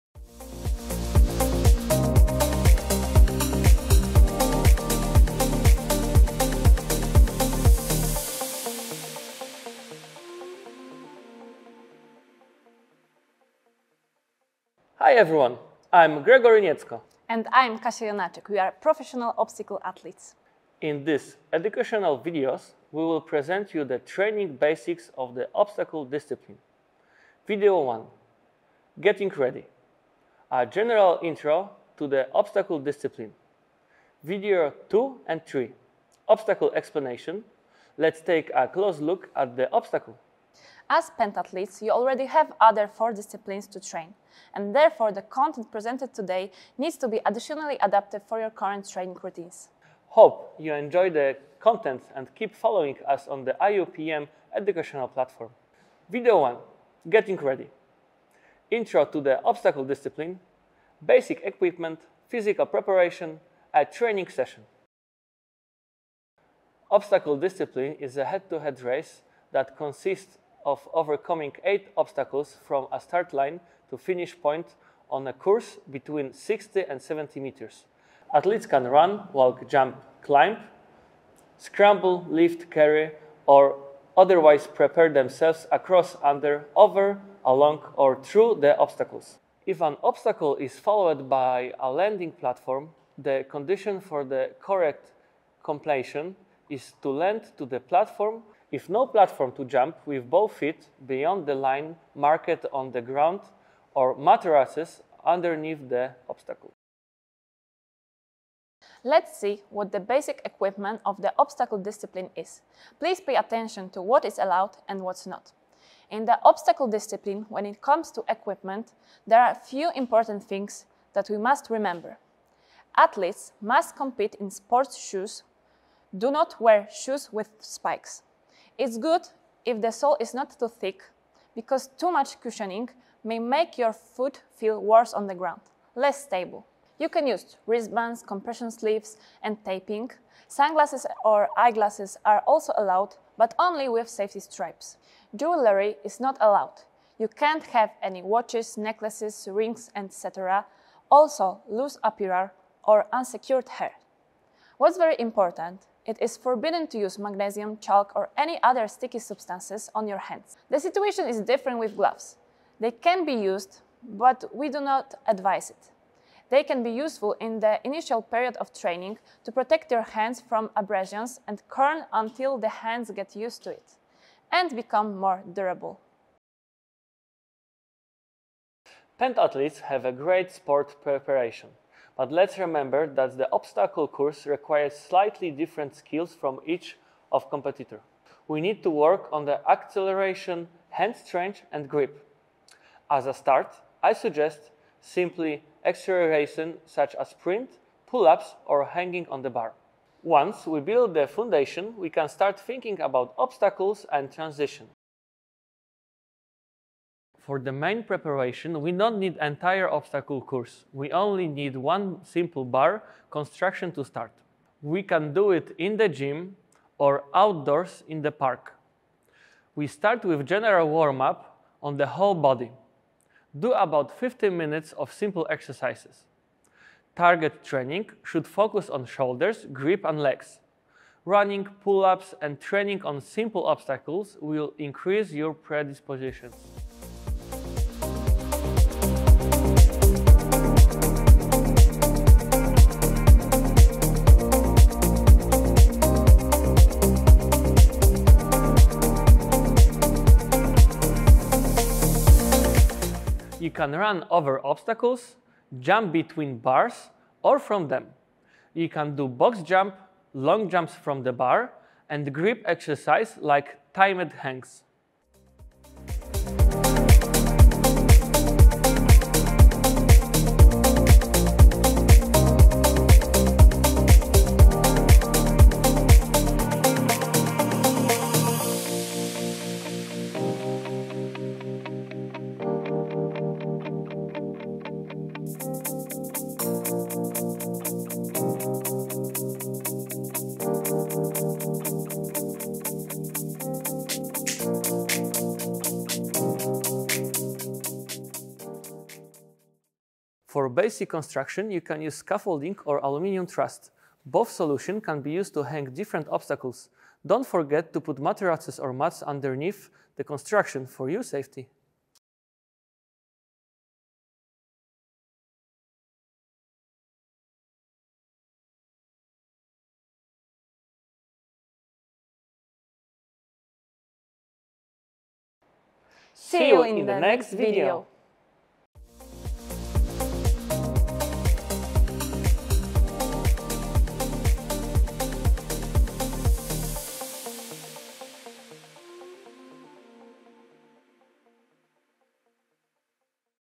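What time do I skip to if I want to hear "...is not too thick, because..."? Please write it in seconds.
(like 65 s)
130 s.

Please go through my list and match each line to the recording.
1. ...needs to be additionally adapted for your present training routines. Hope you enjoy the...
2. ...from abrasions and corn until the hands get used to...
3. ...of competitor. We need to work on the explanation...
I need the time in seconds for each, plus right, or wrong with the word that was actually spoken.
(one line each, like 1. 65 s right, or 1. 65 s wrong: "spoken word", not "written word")
1. 46 s wrong: "current", not "present"
2. 170 s right
3. 187 s wrong: "acceleration", not "explanation".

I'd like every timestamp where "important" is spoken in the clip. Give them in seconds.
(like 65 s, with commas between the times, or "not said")
119 s, 155 s.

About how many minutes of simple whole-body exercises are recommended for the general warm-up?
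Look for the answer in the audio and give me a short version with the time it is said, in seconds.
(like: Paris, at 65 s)
15, at 224 s.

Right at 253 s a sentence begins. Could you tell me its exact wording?
You can run over obstacles, jump between bars or from them.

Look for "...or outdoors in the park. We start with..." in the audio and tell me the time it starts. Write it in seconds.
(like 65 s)
216 s.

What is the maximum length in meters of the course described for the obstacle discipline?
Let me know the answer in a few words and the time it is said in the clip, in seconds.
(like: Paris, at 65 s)
70, at 77 s.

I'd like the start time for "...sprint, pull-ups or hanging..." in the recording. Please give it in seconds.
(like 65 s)
197 s.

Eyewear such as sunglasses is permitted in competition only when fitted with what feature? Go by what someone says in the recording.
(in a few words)
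safety stripes.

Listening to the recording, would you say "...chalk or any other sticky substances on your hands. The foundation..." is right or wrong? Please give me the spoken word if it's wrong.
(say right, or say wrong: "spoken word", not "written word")
wrong: "situation", not "foundation".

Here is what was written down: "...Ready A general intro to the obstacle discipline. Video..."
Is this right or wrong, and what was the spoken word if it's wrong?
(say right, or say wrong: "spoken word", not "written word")
right.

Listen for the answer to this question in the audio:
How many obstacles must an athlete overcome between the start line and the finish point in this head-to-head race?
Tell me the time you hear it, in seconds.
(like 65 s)
71 s.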